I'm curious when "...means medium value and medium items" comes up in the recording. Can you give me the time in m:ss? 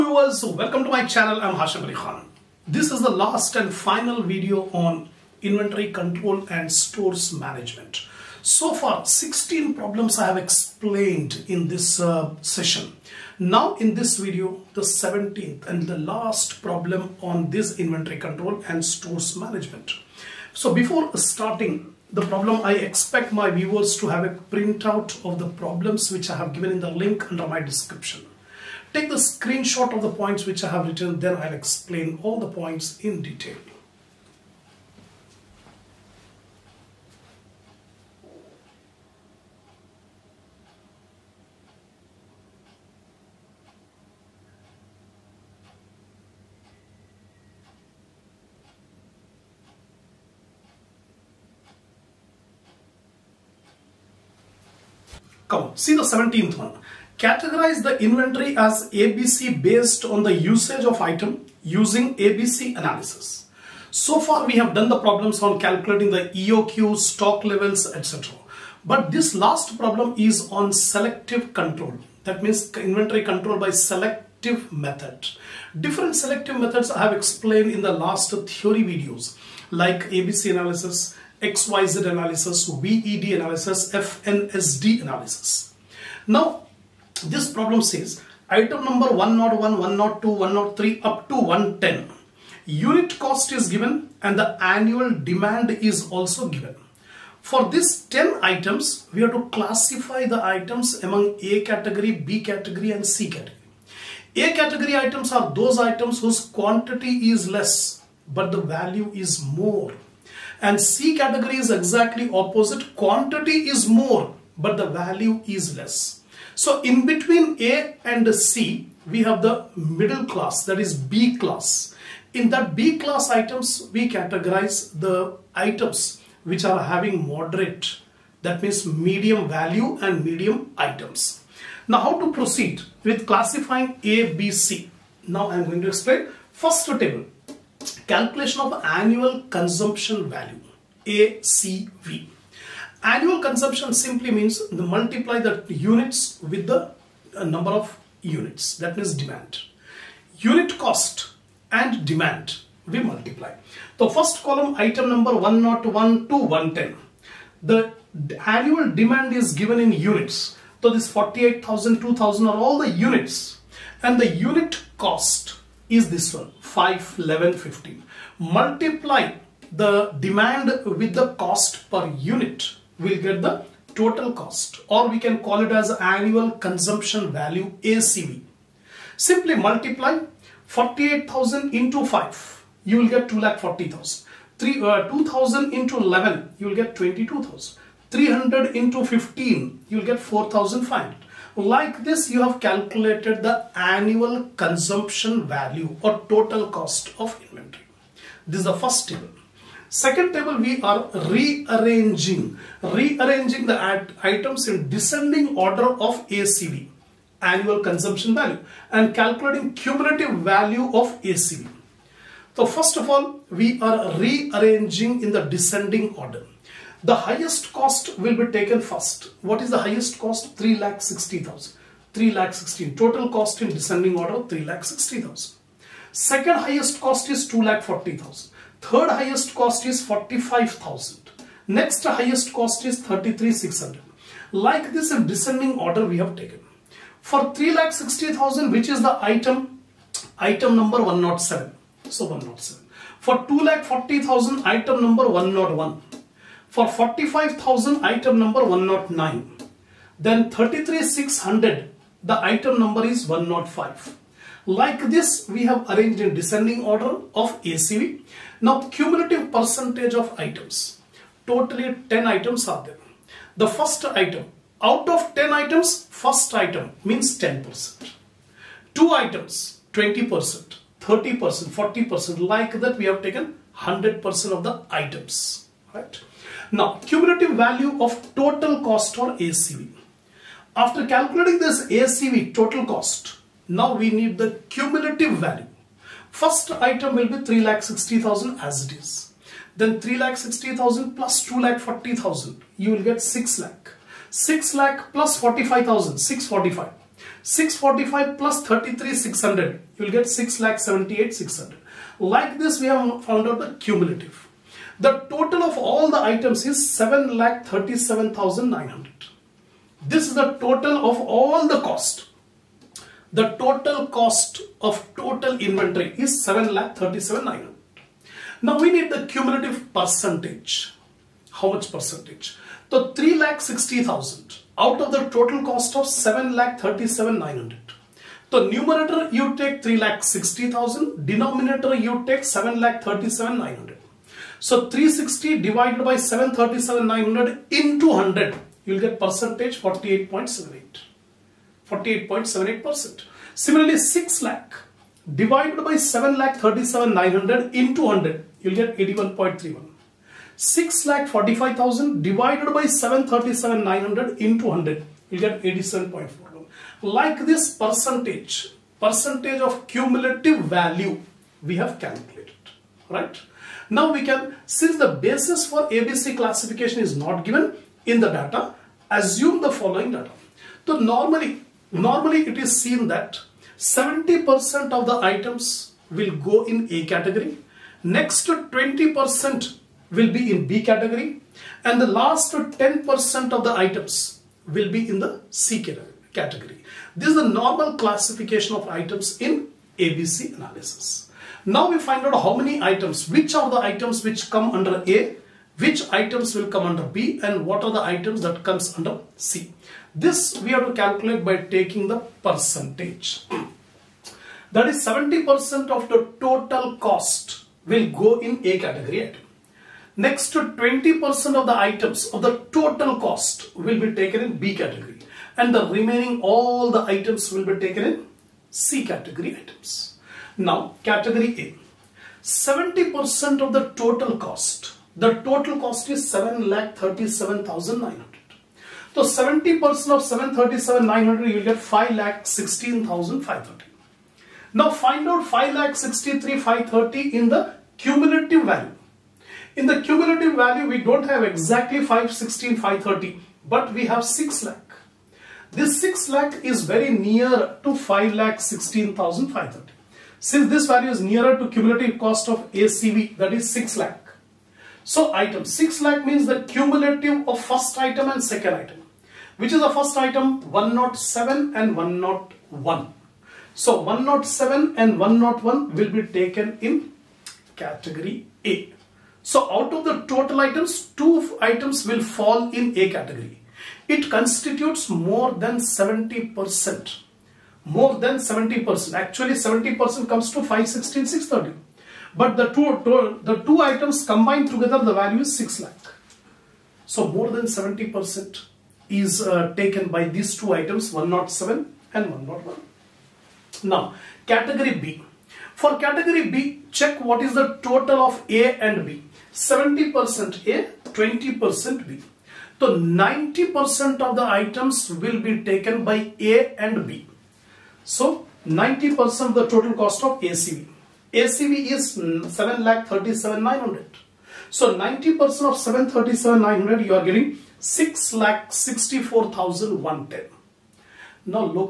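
2:08.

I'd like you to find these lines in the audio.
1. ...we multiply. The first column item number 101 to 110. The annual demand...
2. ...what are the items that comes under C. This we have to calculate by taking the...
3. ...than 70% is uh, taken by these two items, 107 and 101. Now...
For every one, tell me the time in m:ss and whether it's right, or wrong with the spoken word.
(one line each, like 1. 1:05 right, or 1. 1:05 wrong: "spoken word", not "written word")
1. 2:32 right
2. 6:37 right
3. 8:07 right.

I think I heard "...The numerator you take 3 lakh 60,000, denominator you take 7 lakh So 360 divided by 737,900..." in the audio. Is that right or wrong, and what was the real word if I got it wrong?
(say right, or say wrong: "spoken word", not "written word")
right.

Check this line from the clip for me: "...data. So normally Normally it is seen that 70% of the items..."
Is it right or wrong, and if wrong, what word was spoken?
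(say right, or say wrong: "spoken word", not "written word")
right.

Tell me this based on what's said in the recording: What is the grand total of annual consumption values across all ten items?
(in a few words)
7 lakh 37,900.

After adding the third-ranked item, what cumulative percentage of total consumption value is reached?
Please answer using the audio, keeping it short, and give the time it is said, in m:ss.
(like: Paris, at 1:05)
87.41, at 5:55.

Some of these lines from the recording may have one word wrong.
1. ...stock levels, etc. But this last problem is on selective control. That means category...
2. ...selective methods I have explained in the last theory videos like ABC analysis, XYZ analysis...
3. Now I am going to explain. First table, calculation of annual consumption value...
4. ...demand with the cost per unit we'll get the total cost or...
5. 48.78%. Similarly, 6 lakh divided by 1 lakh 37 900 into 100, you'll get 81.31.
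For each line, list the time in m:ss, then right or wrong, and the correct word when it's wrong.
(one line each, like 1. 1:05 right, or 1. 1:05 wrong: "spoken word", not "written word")
1. 1:06 wrong: "inventory", not "category"
2. 1:16 right
3. 2:15 right
4. 2:50 right
5. 5:41 wrong: "7", not "1".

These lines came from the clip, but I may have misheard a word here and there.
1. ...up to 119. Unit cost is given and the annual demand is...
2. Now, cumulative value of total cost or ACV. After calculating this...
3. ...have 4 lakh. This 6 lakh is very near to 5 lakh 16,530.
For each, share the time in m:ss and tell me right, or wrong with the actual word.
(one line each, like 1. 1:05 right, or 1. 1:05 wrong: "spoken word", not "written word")
1. 1:31 wrong: "110", not "119"
2. 4:36 right
3. 7:24 wrong: "6", not "4".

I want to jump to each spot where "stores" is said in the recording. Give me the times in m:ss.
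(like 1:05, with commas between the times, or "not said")
0:06, 0:18.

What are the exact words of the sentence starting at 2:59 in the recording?
Simply multiply 48,000 into 5, you will get 2,40,000.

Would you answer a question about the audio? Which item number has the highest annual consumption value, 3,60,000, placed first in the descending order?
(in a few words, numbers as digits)
107.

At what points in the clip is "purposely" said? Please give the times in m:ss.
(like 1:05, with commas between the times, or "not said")
not said.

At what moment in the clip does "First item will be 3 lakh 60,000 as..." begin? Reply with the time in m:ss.
4:46.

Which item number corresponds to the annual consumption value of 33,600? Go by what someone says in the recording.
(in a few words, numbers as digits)
105.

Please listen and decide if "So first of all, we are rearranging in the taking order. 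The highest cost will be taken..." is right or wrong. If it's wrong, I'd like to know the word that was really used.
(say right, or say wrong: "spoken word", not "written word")
wrong: "descending", not "taking".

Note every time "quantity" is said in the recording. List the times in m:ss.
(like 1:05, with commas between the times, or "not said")
1:46, 1:52.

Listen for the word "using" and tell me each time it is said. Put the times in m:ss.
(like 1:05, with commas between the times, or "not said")
1:01.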